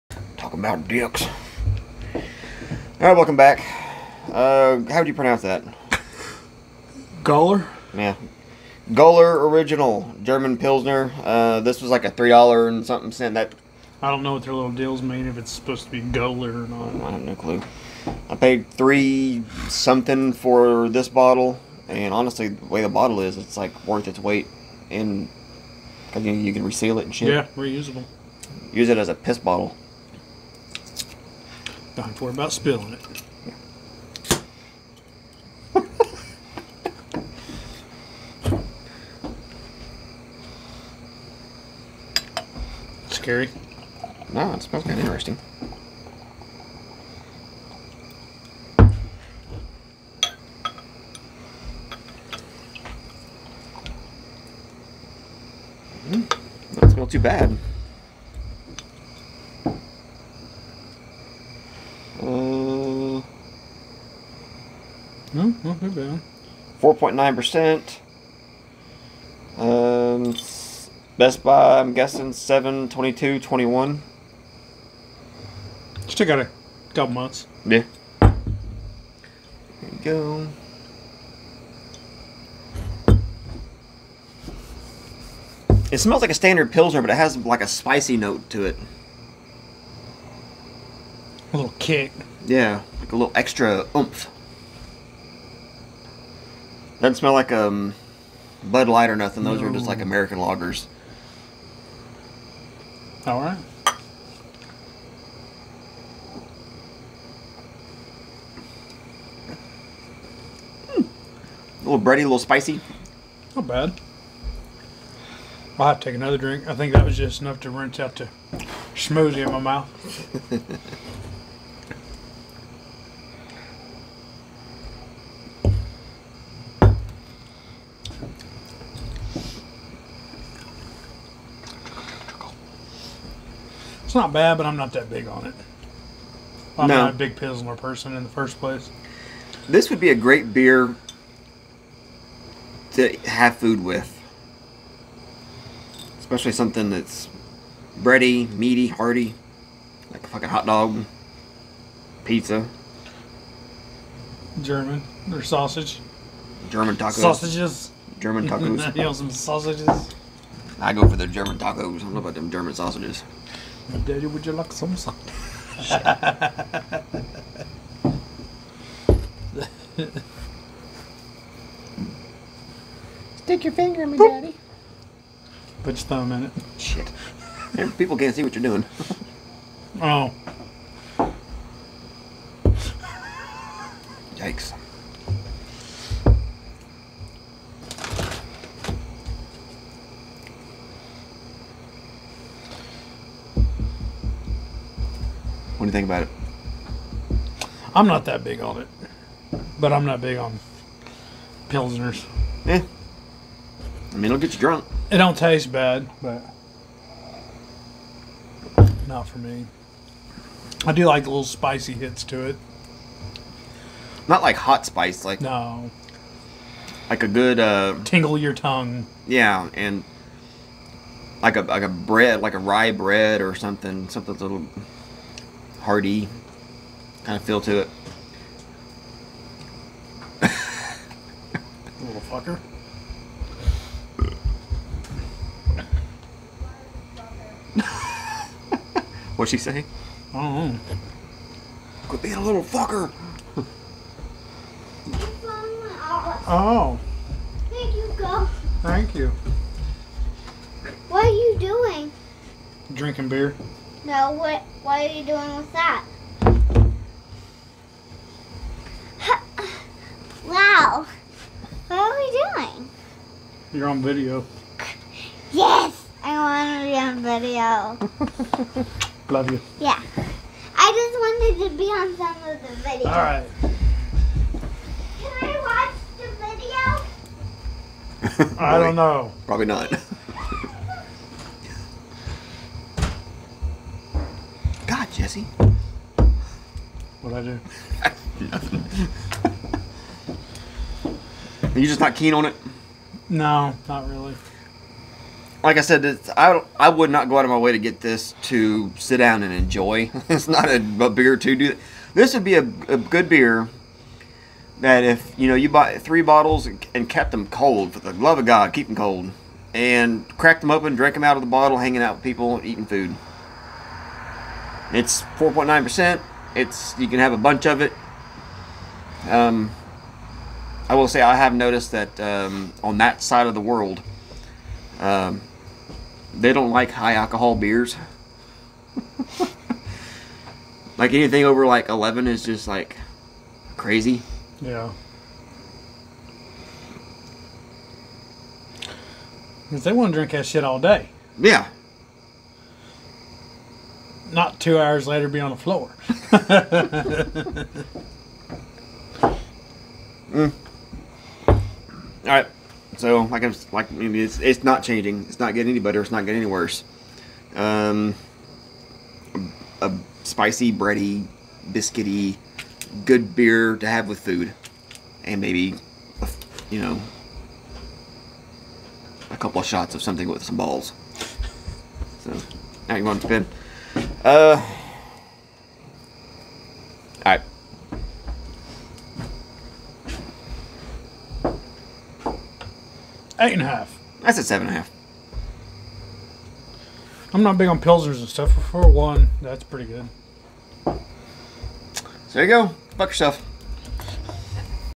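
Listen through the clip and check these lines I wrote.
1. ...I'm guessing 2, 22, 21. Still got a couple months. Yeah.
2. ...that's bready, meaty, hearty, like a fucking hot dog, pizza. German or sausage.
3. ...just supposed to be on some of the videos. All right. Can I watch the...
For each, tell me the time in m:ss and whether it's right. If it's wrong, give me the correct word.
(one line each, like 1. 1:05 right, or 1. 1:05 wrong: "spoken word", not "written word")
1. 1:11 wrong: "7", not "2"
2. 2:26 right
3. 4:30 wrong: "wanted", not "supposed".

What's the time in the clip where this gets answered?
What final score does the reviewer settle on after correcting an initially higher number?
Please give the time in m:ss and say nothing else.
6:24.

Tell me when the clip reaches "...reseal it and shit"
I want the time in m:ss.
0:26.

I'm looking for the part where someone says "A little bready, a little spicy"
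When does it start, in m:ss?
1:51.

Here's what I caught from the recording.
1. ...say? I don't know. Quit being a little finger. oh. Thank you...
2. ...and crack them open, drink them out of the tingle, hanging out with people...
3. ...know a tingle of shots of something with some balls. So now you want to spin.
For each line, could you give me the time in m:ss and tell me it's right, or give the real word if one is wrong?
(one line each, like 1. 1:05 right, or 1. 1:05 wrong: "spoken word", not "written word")
1. 3:59 wrong: "fucker", not "finger"
2. 5:09 wrong: "bottle", not "tingle"
3. 6:06 wrong: "couple", not "tingle".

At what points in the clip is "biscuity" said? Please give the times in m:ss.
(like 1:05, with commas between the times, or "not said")
6:01.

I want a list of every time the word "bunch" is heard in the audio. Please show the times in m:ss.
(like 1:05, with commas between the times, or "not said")
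5:17.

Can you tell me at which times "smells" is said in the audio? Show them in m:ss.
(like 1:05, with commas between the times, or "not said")
0:44, 0:56, 1:25, 1:37.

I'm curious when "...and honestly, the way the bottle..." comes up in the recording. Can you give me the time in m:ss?
0:21.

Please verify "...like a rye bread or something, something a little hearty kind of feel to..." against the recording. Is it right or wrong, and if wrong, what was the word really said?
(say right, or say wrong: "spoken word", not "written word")
right.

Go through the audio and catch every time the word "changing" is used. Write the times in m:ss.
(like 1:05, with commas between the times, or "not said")
5:54.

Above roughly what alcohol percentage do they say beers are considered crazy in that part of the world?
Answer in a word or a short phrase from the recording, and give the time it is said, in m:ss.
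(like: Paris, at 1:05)
11, at 5:31.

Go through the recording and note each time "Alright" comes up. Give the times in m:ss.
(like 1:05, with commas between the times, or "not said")
0:02, 6:17.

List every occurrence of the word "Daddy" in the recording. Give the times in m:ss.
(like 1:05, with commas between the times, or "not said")
2:44, 2:54.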